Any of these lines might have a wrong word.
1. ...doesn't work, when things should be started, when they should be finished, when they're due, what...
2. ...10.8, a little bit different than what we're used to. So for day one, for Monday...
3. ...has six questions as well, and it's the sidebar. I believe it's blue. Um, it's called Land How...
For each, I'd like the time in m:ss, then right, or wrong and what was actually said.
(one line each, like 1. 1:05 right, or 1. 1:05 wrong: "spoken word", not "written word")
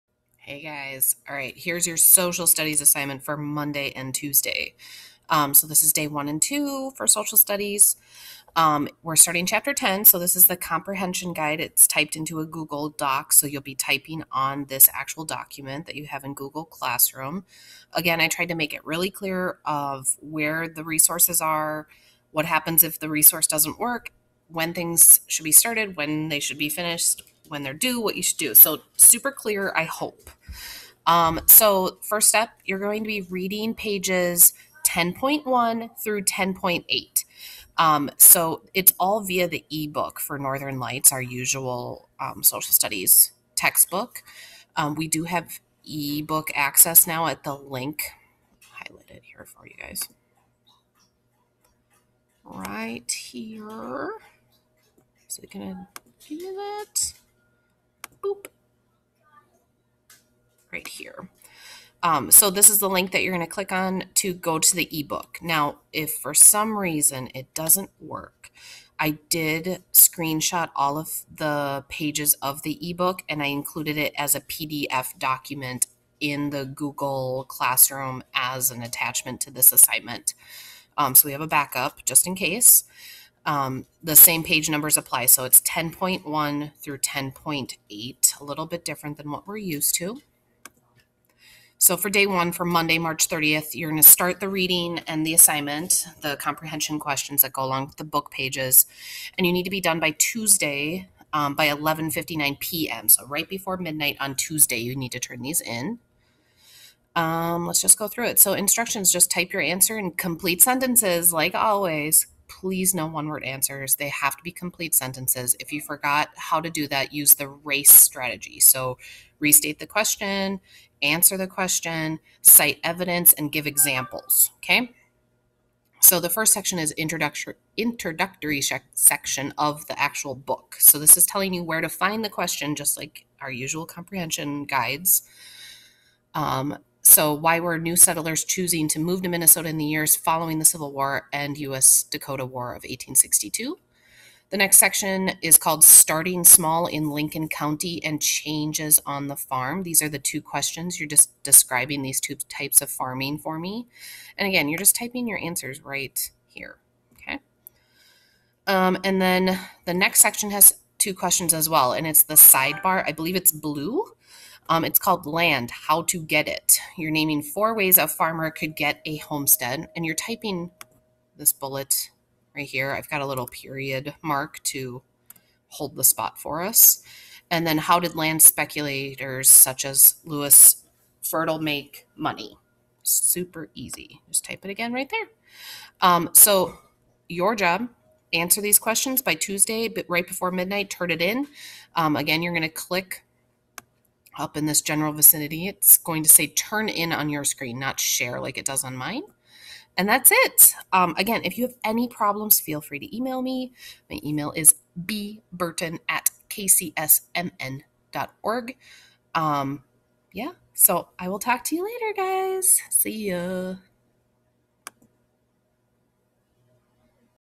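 1. 0:23 right
2. 1:26 right
3. 2:40 wrong: "two", not "six".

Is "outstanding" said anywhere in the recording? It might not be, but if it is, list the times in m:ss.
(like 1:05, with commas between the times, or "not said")
not said.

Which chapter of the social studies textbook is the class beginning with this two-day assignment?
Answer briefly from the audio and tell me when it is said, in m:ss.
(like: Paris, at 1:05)
Chapter 10, at 0:09.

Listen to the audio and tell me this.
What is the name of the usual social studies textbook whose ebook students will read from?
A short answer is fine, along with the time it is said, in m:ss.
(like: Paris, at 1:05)
Northern Lights, at 0:40.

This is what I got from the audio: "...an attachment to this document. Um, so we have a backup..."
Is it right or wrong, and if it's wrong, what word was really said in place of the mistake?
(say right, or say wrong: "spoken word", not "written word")
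wrong: "assignment", not "document".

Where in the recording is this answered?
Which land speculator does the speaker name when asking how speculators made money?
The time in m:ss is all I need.
3:00.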